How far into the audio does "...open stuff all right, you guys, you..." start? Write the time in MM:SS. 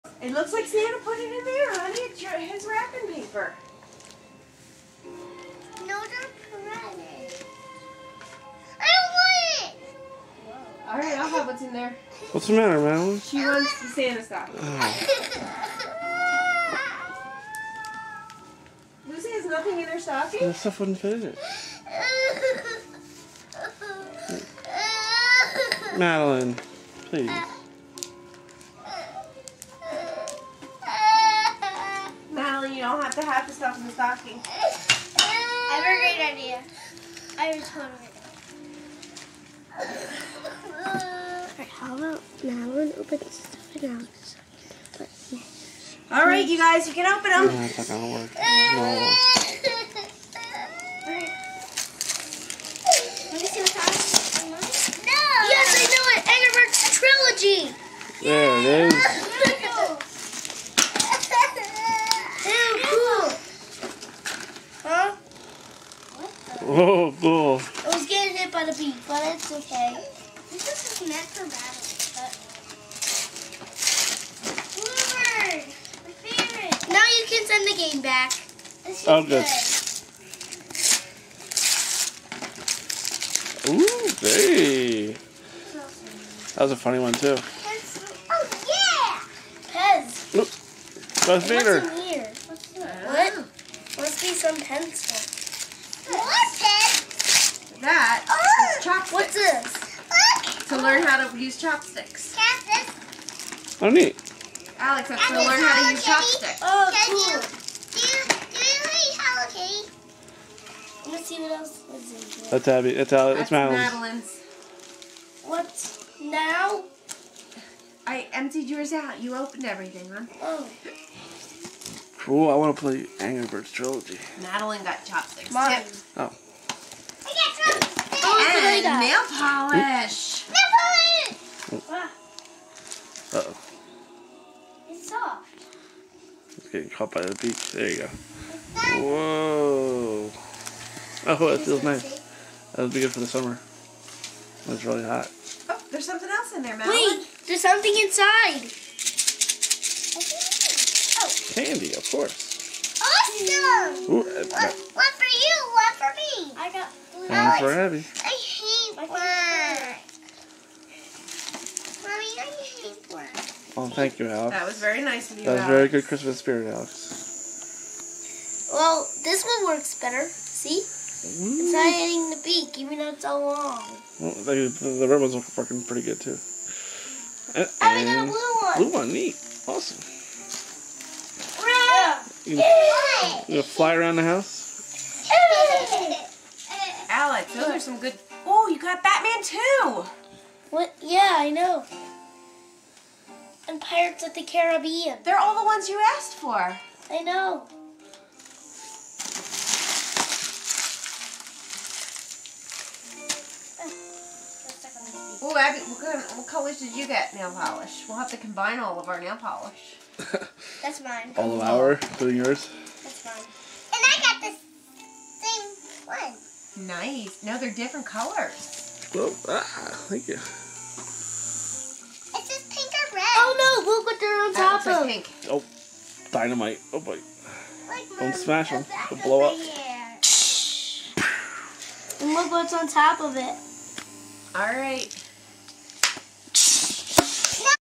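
00:42.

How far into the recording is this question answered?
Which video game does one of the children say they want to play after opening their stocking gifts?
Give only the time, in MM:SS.
02:03.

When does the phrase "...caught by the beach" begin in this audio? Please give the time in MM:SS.
02:16.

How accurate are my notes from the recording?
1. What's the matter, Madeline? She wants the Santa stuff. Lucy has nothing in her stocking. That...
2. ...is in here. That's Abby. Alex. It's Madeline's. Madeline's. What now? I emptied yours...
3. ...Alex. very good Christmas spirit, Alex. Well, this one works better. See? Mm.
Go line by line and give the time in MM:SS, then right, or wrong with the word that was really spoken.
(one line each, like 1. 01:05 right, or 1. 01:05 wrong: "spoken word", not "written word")
1. 00:12 right
2. 01:51 right
3. 02:45 right.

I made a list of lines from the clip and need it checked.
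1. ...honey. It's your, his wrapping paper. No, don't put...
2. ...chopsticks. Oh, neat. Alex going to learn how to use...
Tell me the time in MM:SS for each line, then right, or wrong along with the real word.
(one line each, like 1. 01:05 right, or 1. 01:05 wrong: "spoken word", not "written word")
1. 00:01 right
2. 01:41 right.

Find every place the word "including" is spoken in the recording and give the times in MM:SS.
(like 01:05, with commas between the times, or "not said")
03:31.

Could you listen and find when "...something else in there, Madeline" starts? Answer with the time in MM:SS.
02:26.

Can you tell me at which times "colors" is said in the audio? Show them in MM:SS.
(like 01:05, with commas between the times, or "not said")
03:26, 03:38.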